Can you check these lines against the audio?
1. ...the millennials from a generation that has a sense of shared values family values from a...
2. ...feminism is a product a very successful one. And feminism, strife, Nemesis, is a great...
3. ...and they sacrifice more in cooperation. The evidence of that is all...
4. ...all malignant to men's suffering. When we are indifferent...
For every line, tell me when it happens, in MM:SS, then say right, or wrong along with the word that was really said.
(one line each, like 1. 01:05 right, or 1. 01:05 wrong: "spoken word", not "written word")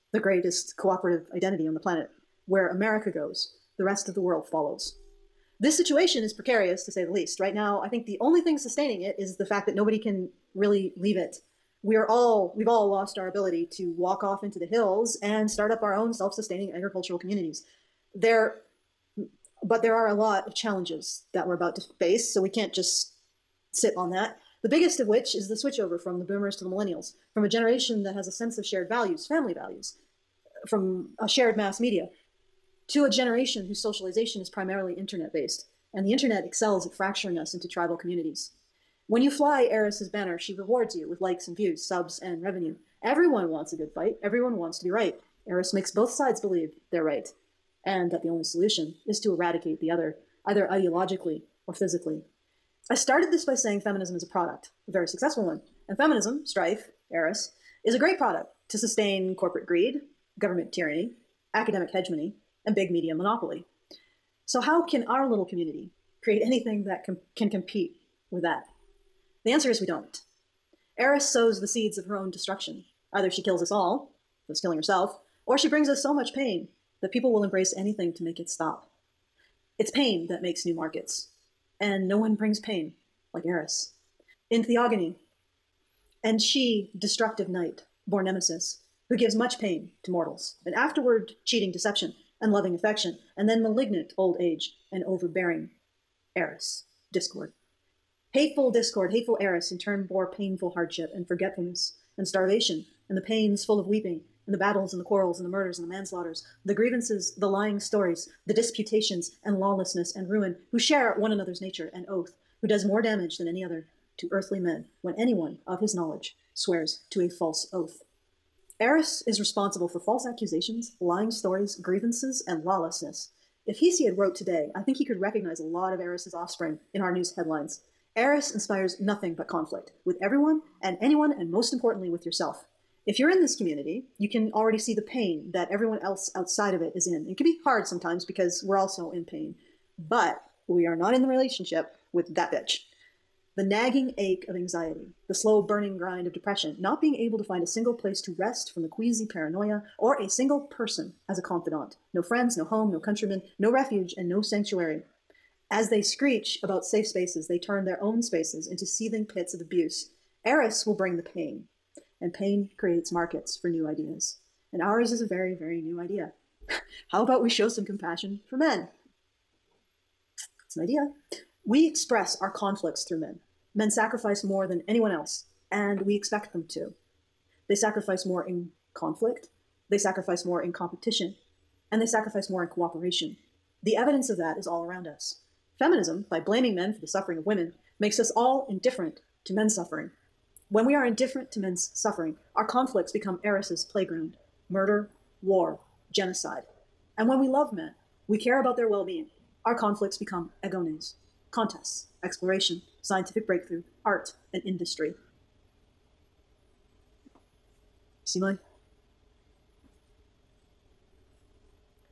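1. 00:26 right
2. 00:53 wrong: "Eris", not "Nemesis"
3. 03:01 right
4. 03:08 wrong: "indifferent", not "malignant".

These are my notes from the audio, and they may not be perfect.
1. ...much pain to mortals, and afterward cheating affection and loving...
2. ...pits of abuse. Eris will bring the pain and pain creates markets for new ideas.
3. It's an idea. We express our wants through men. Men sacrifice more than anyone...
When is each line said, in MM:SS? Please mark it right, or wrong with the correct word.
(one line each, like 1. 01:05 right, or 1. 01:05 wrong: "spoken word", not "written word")
1. 01:29 wrong: "deception", not "affection"
2. 02:39 right
3. 02:50 wrong: "conflicts", not "wants".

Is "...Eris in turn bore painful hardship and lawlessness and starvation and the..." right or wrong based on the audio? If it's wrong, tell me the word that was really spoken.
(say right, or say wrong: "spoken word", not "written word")
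wrong: "forgetfulness", not "lawlessness".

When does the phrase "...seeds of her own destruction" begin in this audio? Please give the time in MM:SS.
01:11.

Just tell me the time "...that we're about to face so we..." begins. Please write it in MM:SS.
00:21.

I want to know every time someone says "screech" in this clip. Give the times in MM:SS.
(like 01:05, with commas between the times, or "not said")
02:36.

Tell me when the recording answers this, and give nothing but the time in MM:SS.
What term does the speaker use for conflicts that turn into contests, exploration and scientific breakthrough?
03:20.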